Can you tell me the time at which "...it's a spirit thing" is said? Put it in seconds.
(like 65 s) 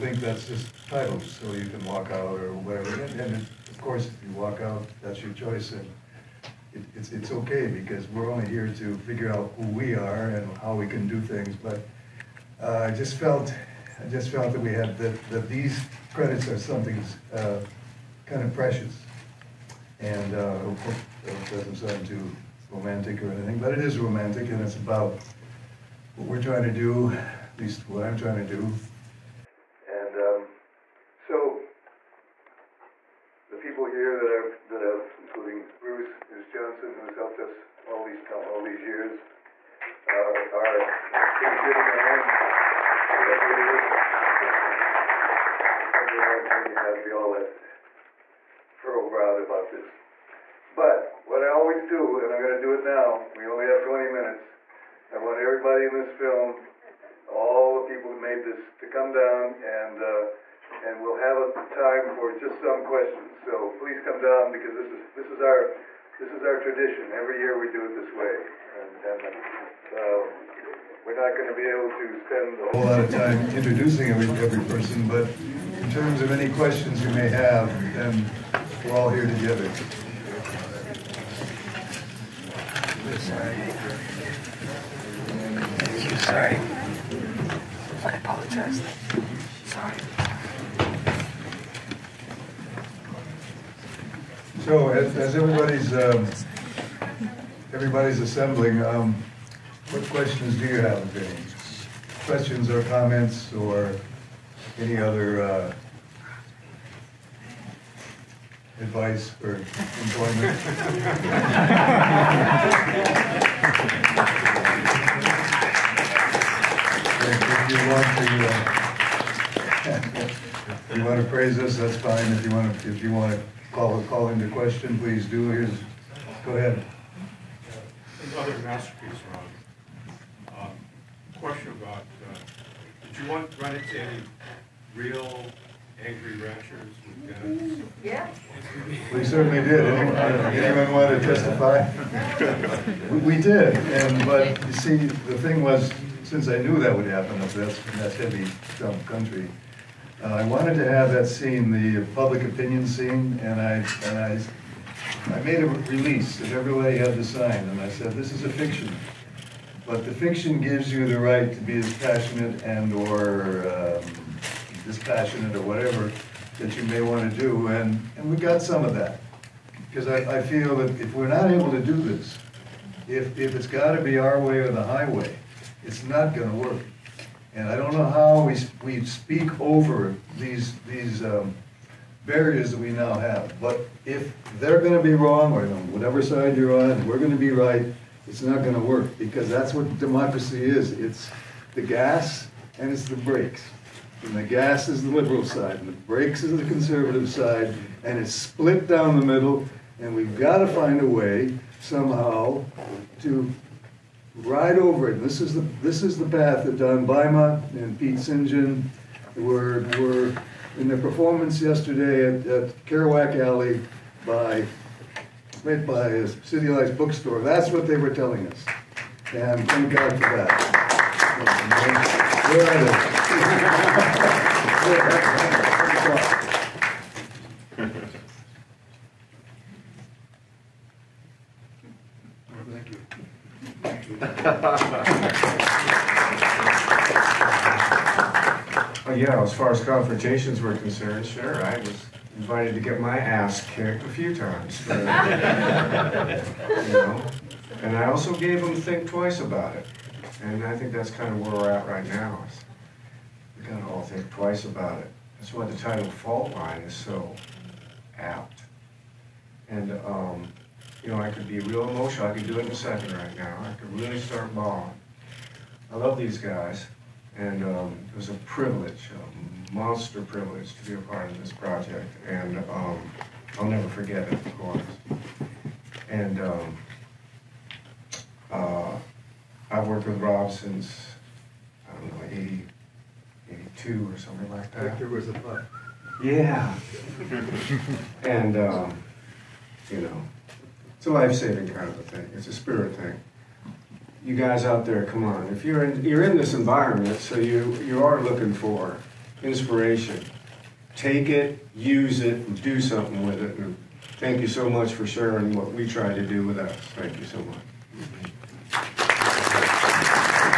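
292 s.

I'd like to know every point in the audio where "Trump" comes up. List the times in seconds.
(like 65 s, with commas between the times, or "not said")
148 s.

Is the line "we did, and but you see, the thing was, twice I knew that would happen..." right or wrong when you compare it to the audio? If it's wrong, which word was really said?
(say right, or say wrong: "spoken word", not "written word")
wrong: "since", not "twice".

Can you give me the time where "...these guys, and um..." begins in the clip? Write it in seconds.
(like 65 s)
266 s.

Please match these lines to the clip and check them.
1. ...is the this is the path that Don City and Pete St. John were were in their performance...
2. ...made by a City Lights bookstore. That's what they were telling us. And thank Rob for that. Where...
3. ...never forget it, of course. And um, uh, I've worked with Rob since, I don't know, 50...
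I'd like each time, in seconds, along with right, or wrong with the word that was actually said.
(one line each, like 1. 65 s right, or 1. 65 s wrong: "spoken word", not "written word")
1. 205 s wrong: "Bima", not "City"
2. 215 s wrong: "God", not "Rob"
3. 273 s wrong: "80", not "50".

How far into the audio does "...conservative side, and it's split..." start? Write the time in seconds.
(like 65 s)
196 s.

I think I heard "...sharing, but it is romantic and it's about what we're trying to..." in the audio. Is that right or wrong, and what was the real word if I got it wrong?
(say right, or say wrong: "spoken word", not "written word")
wrong: "anything", not "sharing".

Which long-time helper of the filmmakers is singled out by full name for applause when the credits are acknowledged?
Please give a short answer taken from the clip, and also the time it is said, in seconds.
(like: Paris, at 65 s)
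Bruce Johnson, at 36 s.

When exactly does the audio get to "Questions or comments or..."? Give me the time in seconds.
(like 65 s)
102 s.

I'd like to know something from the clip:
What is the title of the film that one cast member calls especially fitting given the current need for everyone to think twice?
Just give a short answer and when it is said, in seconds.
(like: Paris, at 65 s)
Faultline, at 256 s.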